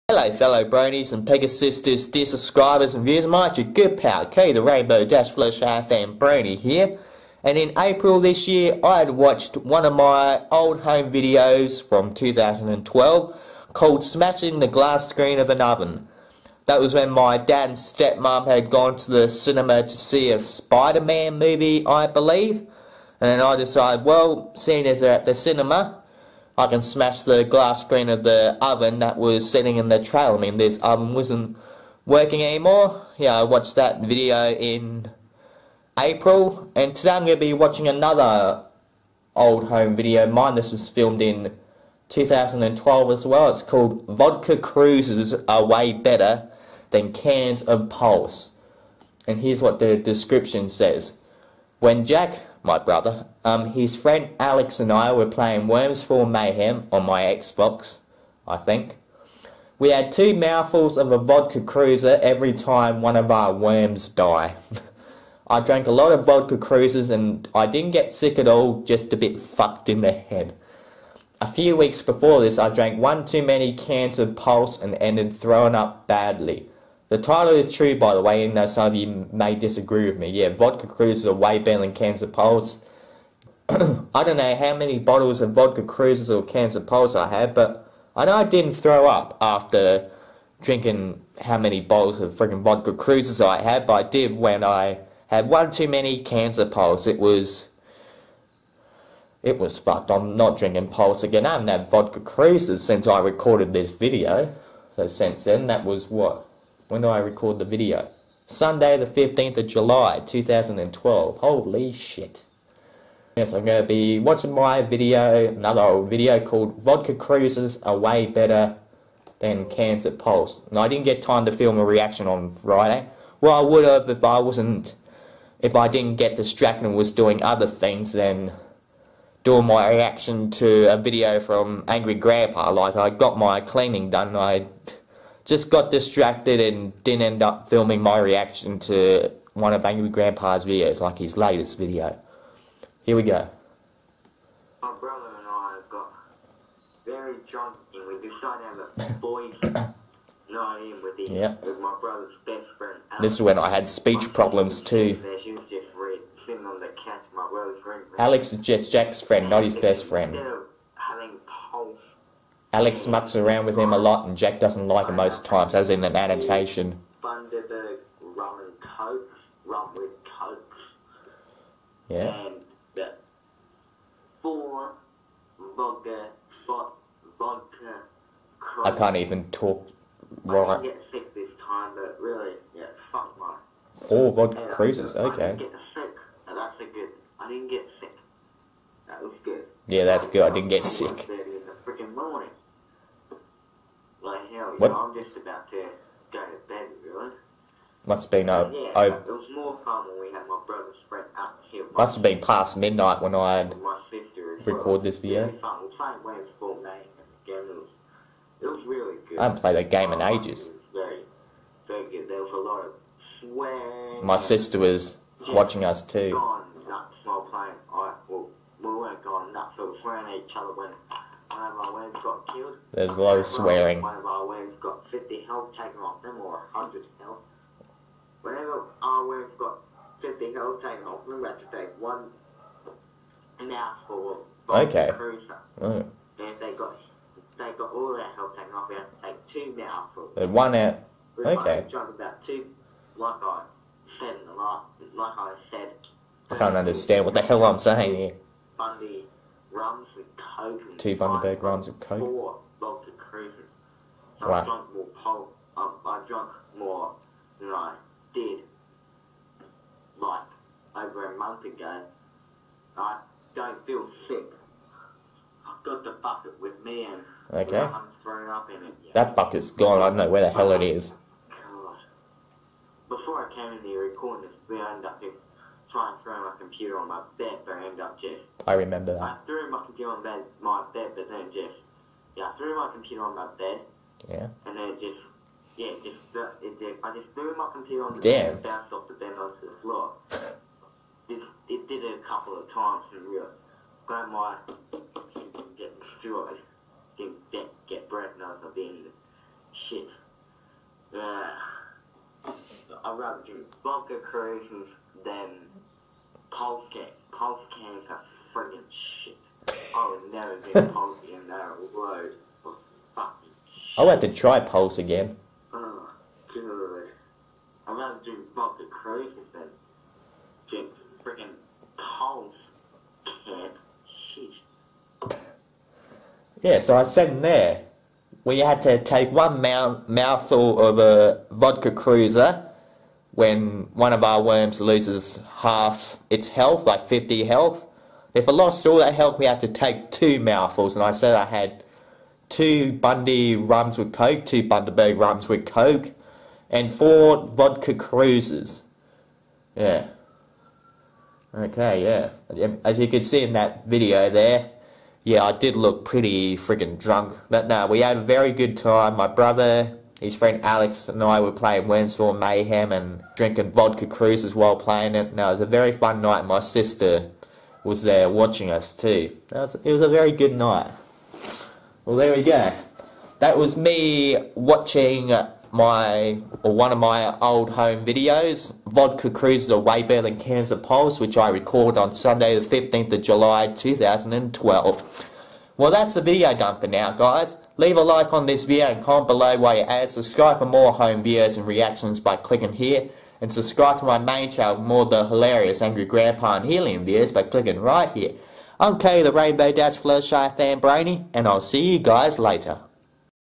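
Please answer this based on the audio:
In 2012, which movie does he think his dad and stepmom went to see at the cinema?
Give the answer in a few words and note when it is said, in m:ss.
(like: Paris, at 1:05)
Spider-Man, at 0:20.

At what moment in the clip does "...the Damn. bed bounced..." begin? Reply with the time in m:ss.
4:48.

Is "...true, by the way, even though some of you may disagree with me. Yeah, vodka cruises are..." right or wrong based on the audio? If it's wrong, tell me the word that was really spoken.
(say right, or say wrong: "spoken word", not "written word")
right.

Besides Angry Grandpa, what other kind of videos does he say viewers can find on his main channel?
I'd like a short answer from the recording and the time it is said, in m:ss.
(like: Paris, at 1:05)
Helium videos, at 6:36.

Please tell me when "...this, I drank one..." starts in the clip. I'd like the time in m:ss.
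1:12.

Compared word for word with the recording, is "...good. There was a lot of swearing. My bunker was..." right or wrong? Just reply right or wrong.
wrong.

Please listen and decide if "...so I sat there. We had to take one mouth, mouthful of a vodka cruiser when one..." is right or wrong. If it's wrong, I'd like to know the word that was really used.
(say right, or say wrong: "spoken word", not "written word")
right.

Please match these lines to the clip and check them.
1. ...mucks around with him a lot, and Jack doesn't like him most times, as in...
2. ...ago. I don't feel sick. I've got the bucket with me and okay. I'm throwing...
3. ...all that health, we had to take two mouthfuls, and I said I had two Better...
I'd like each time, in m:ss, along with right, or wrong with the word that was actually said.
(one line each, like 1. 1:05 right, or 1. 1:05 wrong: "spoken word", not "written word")
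1. 2:43 right
2. 4:21 right
3. 5:38 wrong: "Bundy", not "Better".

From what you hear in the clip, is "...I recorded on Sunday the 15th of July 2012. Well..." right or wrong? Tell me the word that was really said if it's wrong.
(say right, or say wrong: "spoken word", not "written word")
right.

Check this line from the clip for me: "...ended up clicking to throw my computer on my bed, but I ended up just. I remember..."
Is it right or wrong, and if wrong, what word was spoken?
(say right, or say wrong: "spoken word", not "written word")
wrong: "trying", not "clicking".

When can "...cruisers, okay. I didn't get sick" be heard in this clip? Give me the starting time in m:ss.
3:04.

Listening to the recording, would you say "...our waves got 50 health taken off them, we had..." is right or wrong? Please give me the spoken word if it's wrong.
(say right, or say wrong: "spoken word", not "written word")
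right.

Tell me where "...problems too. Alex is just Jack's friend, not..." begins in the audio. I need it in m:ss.
2:34.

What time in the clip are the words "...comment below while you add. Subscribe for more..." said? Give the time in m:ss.
6:29.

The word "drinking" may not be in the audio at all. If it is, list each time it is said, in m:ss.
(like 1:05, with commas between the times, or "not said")
1:30, 1:40, 6:03.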